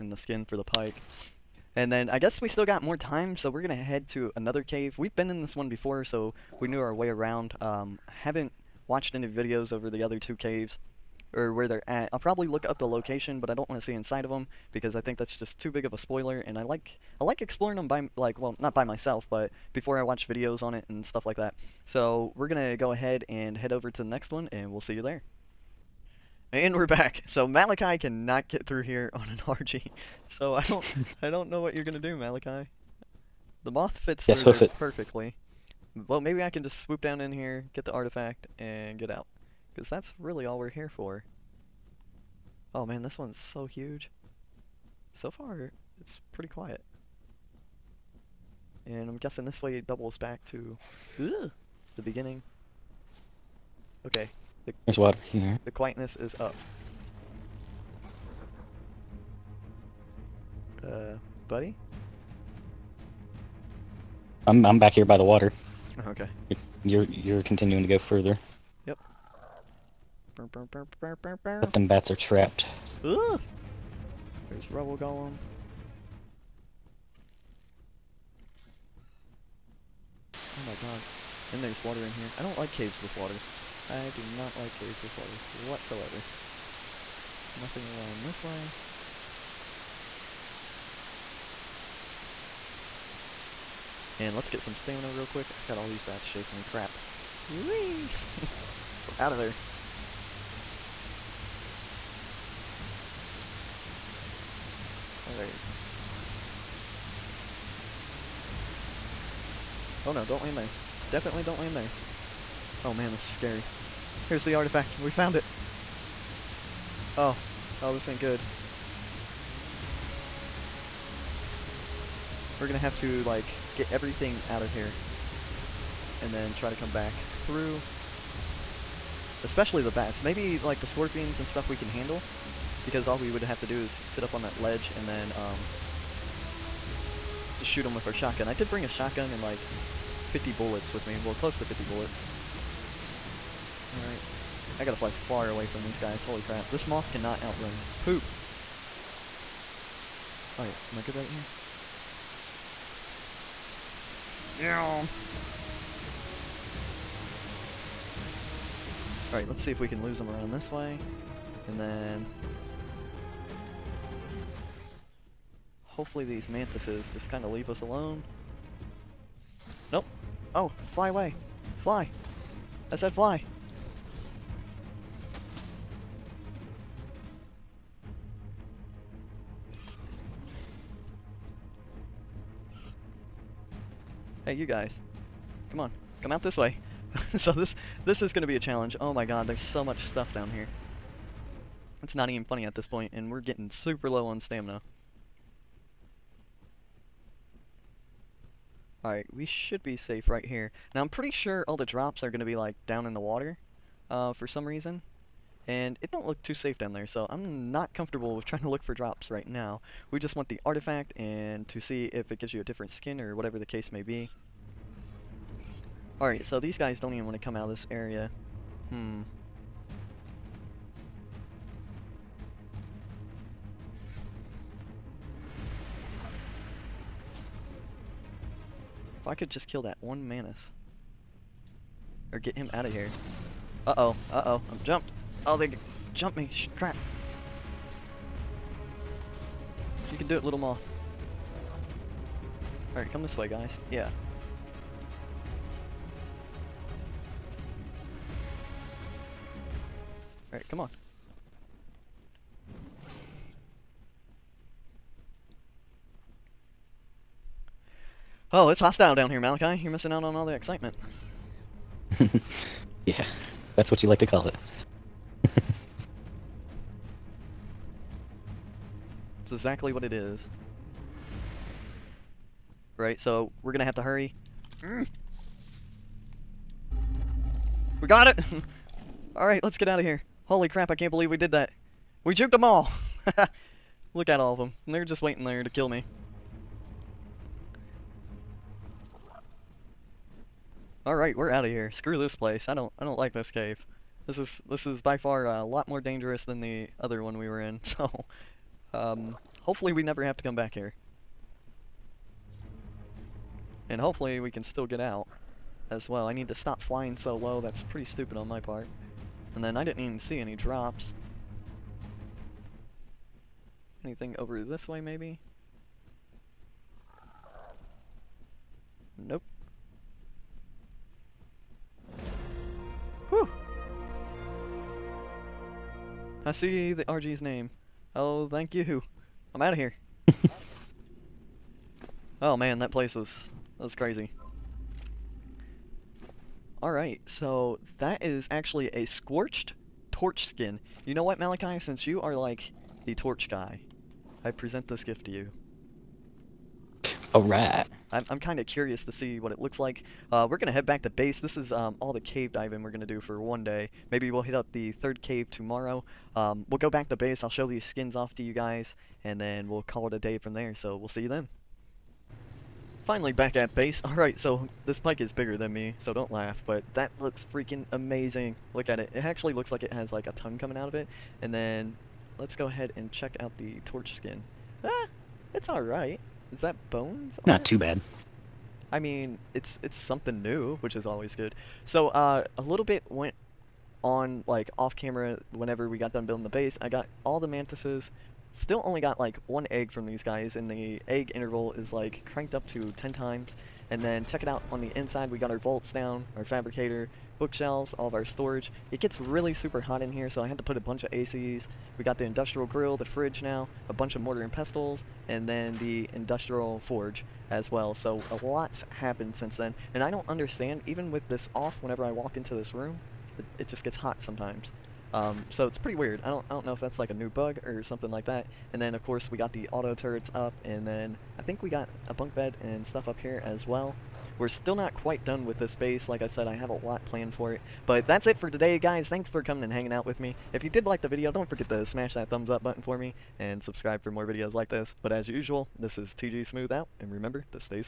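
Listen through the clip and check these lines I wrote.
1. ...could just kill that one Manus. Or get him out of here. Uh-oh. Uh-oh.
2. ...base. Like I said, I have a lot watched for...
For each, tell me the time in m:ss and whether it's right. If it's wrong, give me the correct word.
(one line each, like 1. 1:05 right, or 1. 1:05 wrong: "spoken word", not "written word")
1. 3:49 right
2. 7:05 wrong: "planned", not "watched".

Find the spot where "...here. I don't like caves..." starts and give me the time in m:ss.
1:22.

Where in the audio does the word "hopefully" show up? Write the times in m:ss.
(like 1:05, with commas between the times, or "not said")
2:45, 4:59, 5:03.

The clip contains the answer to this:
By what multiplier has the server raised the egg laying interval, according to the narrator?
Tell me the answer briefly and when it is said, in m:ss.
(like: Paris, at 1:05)
10 times, at 6:32.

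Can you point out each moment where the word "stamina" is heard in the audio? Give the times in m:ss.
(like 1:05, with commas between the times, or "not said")
1:34, 3:14.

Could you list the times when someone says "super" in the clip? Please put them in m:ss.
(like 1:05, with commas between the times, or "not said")
3:13, 6:39.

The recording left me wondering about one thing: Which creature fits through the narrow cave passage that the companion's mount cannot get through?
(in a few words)
The moth.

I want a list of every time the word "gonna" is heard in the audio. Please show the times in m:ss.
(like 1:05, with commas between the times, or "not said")
0:31, 2:02, 4:33.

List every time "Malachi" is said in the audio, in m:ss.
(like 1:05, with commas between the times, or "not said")
0:27, 0:32, 4:19, 5:41.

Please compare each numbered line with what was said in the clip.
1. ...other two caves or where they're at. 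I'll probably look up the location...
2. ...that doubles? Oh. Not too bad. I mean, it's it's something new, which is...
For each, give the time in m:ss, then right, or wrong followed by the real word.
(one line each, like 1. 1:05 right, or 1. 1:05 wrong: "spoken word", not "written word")
1. 0:10 right
2. 6:16 wrong: "bones", not "doubles".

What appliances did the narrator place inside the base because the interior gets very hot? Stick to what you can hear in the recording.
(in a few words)
ACs.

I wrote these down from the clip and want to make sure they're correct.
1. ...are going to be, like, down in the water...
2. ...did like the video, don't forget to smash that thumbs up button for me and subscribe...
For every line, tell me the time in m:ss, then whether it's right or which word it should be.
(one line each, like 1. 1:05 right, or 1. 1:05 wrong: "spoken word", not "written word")
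1. 3:22 right
2. 7:10 right.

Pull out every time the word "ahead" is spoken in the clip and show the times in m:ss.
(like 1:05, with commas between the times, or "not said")
0:22, 6:12.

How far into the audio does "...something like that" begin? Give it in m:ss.
6:57.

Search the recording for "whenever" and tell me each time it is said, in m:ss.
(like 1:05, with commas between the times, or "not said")
6:25, 6:51.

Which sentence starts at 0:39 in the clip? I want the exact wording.
Because that's really all we're here for.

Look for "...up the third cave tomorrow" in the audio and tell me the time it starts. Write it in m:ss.
5:54.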